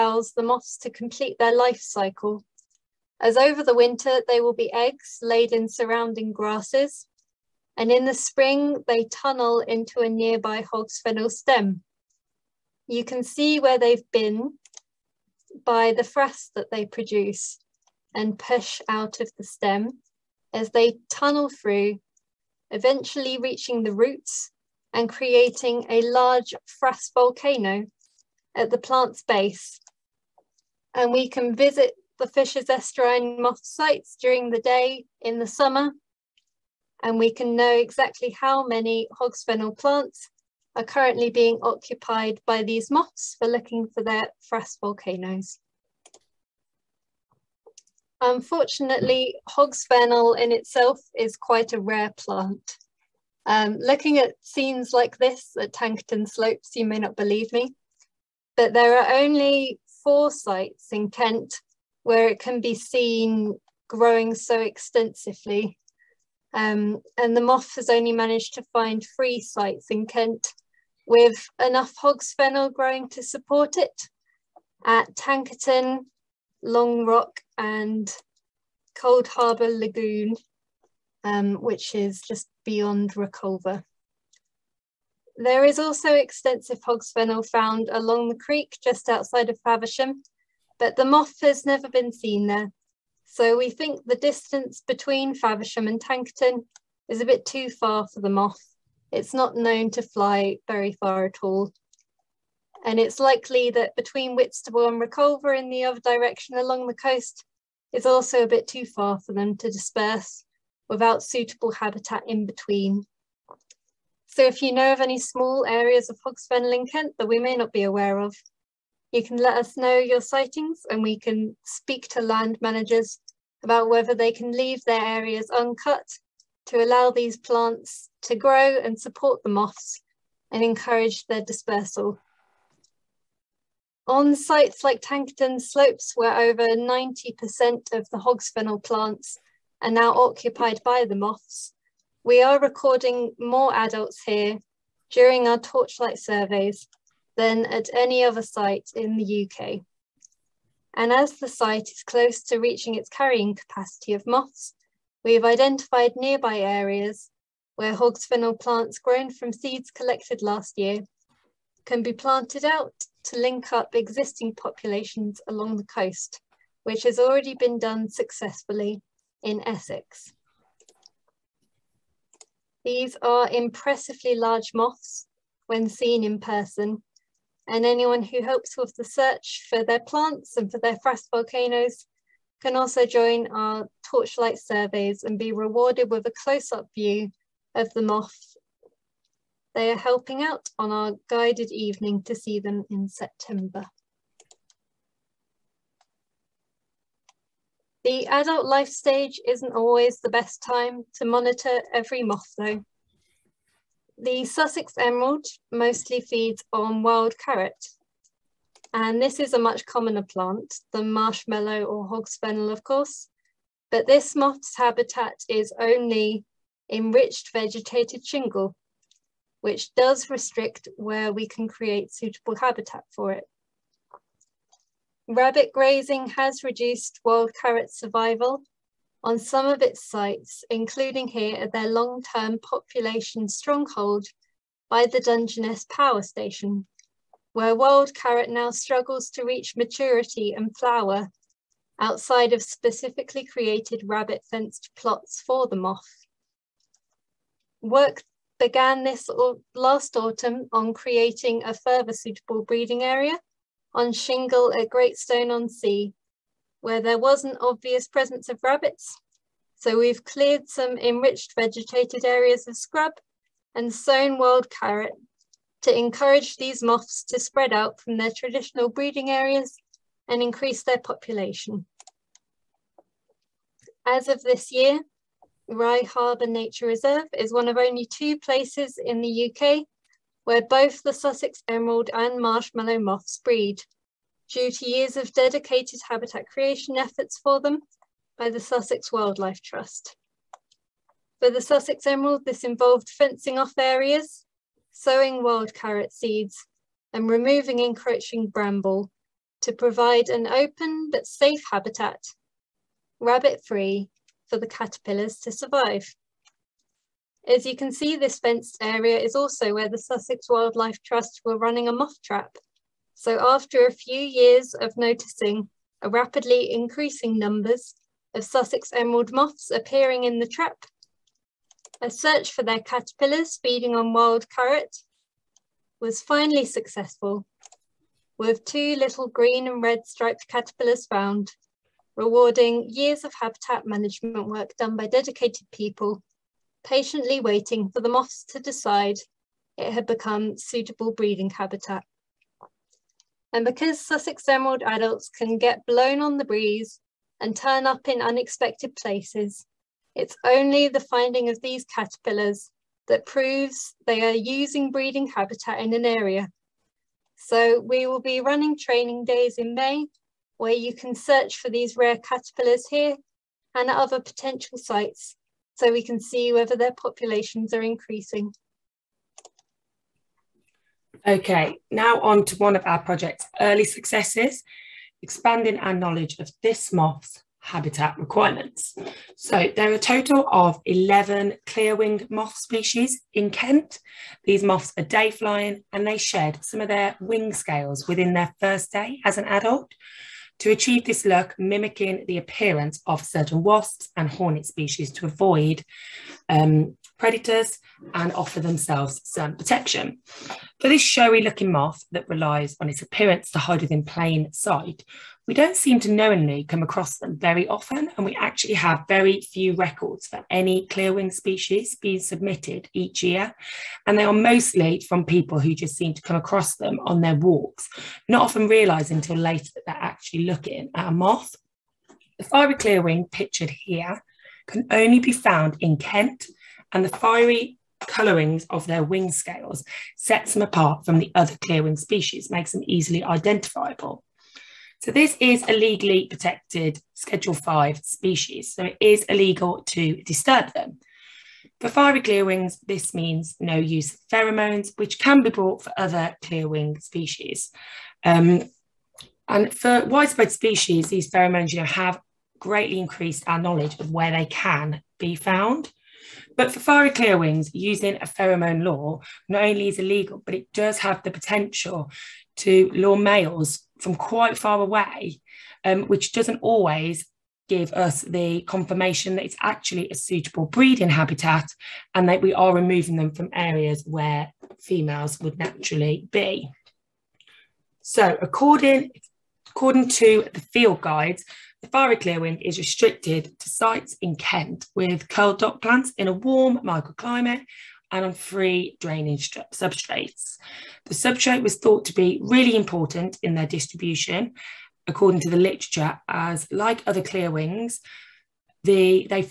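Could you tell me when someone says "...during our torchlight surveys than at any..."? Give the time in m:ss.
2:25.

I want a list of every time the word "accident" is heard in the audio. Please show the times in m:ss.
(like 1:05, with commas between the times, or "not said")
not said.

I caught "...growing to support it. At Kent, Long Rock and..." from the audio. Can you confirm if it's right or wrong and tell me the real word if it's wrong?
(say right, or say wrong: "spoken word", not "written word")
wrong: "Tankerton", not "Kent".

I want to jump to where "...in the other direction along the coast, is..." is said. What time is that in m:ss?
1:45.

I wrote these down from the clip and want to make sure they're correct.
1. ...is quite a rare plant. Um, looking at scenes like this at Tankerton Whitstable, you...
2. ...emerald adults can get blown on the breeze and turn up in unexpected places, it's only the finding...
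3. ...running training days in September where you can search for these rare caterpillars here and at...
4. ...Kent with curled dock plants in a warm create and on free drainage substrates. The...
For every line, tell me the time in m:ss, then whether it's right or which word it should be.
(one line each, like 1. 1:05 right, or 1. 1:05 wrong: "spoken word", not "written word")
1. 0:51 wrong: "Slopes", not "Whitstable"
2. 5:44 right
3. 5:58 wrong: "May", not "September"
4. 8:04 wrong: "microclimate", not "create".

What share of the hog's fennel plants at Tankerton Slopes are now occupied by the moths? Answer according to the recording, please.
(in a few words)
over 90%.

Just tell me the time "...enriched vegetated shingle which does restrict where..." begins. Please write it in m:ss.
3:36.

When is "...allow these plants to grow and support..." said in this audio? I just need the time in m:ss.
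2:06.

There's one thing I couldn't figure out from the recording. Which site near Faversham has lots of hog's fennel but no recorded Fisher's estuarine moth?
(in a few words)
the creek.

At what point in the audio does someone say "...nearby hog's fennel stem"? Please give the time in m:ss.
0:10.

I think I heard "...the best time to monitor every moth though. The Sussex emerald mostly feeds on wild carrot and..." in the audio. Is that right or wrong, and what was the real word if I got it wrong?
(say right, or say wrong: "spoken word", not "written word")
right.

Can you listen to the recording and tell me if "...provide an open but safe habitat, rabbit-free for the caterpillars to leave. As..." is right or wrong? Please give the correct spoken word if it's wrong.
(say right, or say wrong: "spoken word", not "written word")
wrong: "survive", not "leave".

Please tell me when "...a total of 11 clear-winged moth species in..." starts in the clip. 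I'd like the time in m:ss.
6:19.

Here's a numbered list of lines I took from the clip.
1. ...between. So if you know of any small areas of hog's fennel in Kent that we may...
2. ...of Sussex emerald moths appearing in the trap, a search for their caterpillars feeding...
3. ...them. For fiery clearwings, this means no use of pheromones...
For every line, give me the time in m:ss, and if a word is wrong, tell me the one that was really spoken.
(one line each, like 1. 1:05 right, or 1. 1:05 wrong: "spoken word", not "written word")
1. 1:52 right
2. 5:18 right
3. 7:20 right.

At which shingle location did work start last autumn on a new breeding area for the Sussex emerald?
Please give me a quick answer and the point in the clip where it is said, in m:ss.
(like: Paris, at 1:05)
Great Stone on sea, at 4:14.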